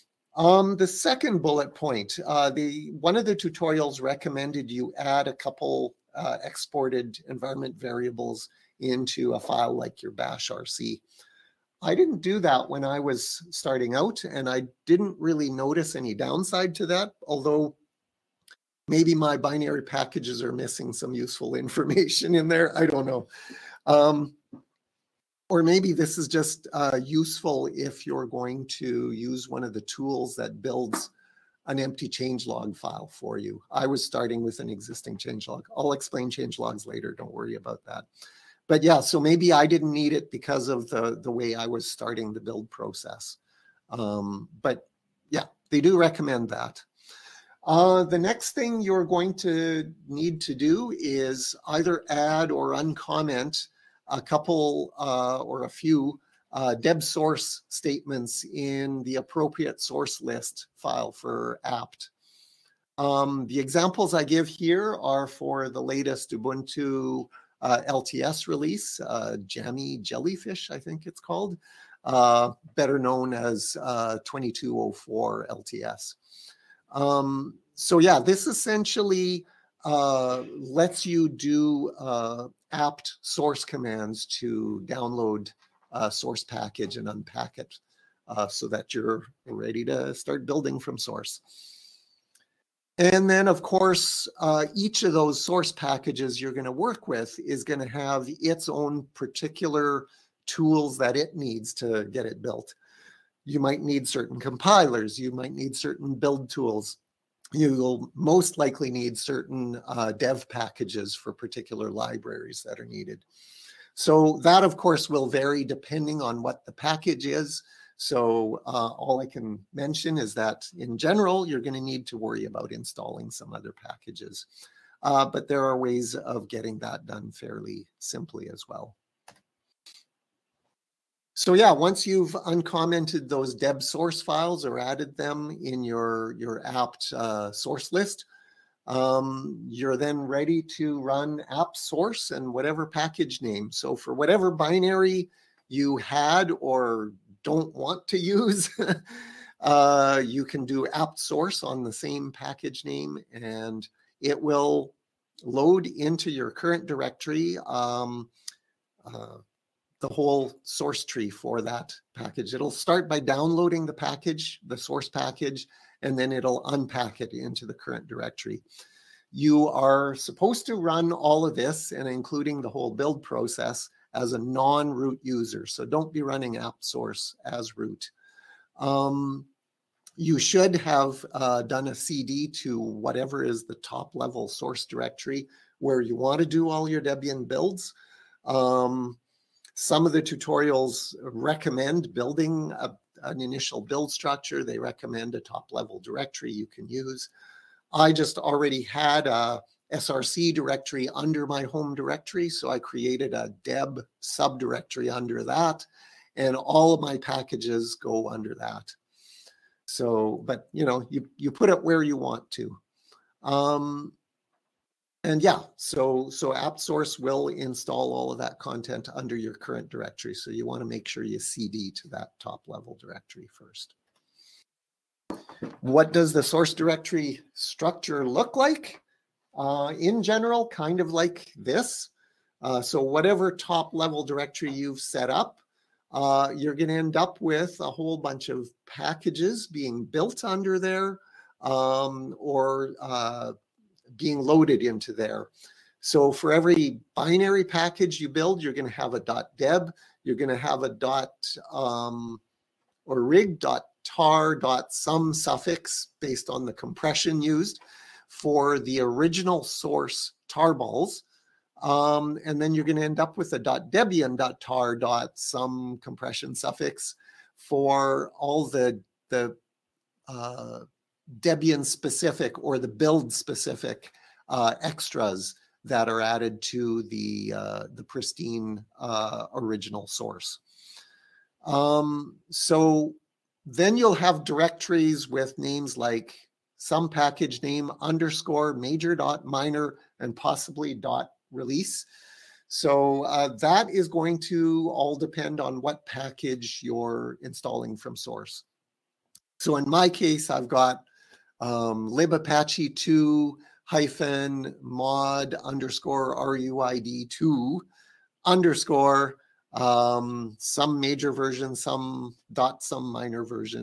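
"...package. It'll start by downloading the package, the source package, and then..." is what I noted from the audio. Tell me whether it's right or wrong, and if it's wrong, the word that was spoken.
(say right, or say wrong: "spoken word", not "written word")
right.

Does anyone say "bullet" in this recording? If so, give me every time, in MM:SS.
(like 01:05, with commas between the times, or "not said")
00:01.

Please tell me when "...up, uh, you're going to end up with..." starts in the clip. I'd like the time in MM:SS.
03:55.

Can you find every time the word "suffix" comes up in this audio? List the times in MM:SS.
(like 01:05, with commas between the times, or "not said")
04:15, 04:26.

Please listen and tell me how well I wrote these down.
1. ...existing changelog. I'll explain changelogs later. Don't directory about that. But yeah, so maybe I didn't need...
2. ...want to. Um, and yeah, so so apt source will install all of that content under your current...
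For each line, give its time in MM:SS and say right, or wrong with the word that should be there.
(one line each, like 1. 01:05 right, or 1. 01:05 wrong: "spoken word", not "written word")
1. 00:34 wrong: "worry", not "directory"
2. 03:32 right.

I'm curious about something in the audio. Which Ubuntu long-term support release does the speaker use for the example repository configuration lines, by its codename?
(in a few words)
Jammy Jellyfish.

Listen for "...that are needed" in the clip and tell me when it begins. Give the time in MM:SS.
01:52.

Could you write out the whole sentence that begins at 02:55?
So don't be running apt source as root.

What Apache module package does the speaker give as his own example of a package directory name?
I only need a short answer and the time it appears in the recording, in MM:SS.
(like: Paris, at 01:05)
libapache2-mod-ruid2, at 05:02.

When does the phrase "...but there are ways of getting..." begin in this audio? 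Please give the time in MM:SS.
02:05.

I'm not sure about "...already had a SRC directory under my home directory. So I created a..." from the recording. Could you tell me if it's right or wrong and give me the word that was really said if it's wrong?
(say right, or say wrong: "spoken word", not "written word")
right.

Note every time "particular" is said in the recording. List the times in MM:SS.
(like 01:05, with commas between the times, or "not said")
01:39, 01:51.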